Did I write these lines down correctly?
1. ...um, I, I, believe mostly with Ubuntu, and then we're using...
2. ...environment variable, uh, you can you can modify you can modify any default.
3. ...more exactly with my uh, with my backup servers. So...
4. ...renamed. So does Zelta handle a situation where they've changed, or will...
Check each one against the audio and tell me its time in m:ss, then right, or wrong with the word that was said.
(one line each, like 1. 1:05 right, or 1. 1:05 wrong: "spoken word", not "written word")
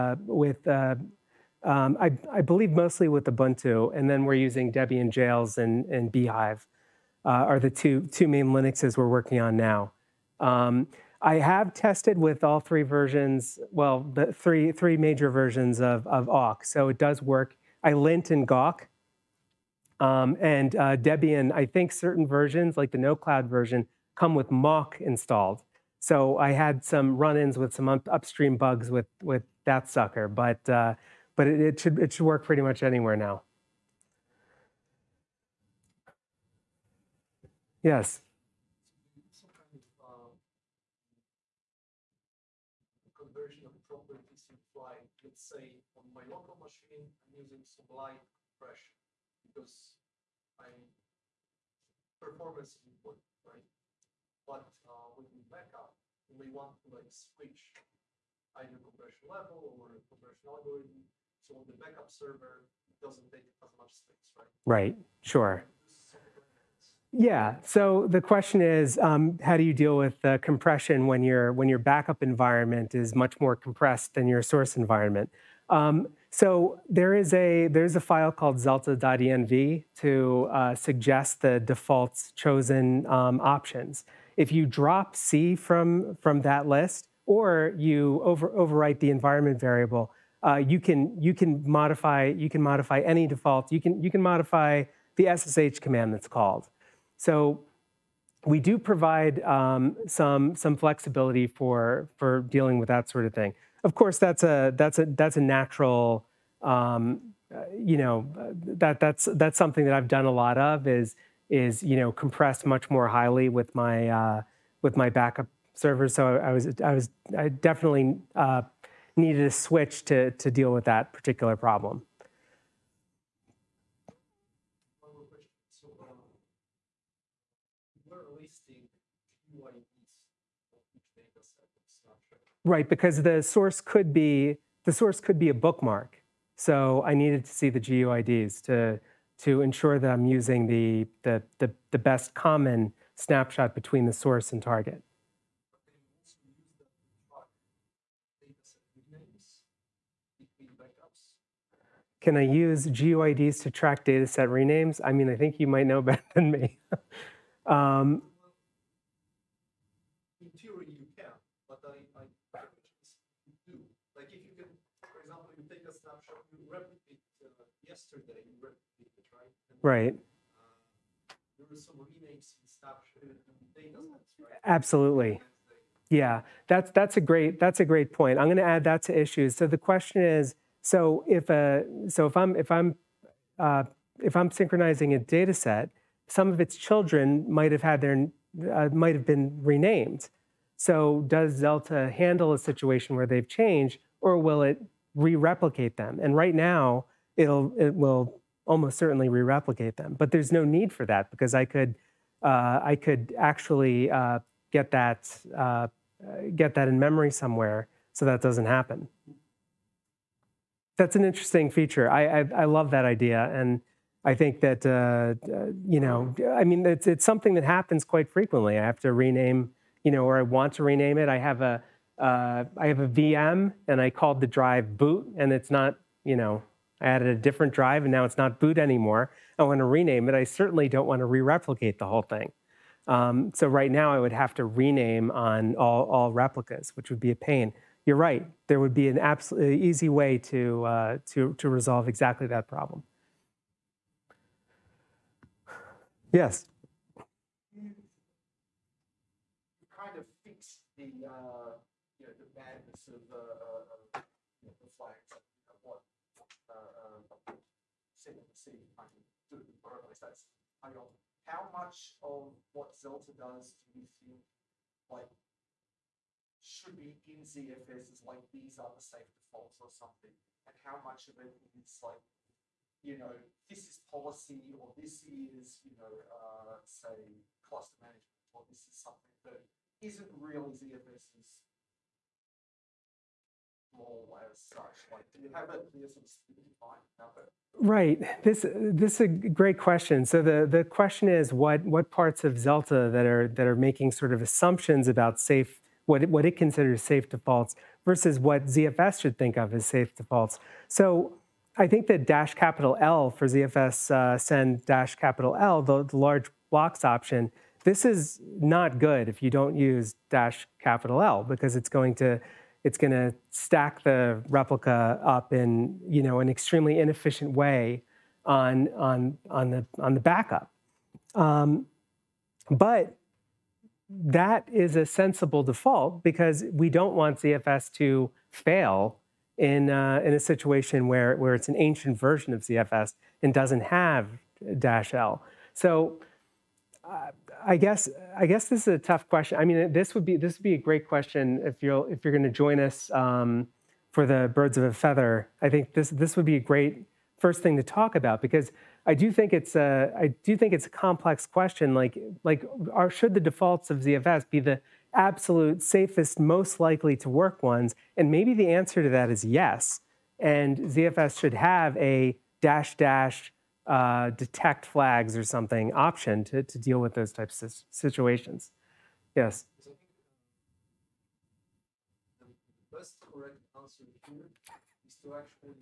1. 0:01 right
2. 1:29 right
3. 1:52 wrong: "highly", not "exactly"
4. 3:09 right.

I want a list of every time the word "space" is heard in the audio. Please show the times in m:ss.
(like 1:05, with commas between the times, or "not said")
1:03.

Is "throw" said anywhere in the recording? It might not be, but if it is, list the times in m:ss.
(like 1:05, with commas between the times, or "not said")
not said.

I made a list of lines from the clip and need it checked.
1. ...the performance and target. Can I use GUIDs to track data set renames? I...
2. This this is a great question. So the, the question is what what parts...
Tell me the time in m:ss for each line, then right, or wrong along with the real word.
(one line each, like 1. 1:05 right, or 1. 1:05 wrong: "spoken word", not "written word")
1. 2:24 wrong: "source", not "performance"
2. 4:48 right.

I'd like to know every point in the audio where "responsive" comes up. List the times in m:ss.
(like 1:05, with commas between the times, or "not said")
not said.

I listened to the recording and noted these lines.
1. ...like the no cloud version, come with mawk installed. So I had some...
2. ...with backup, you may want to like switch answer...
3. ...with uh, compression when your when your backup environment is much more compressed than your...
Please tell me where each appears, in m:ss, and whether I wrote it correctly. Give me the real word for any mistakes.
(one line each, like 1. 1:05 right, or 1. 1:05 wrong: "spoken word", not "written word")
1. 0:22 right
2. 0:55 wrong: "either", not "answer"
3. 1:09 right.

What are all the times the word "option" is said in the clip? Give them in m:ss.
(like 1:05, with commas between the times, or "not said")
1:23, 5:07, 6:05.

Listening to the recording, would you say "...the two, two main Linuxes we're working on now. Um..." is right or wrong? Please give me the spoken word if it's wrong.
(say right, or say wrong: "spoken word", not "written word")
right.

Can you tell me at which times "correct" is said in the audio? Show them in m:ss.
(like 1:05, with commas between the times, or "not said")
6:13.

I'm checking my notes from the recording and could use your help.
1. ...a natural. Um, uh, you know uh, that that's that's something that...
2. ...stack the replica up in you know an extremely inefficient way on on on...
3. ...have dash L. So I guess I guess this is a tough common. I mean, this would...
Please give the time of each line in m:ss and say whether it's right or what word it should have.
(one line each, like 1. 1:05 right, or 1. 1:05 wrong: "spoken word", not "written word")
1. 1:45 right
2. 5:13 right
3. 5:33 wrong: "question", not "common".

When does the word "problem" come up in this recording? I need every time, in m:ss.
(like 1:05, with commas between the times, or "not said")
2:01, 4:02.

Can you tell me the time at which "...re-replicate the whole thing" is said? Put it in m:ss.
3:51.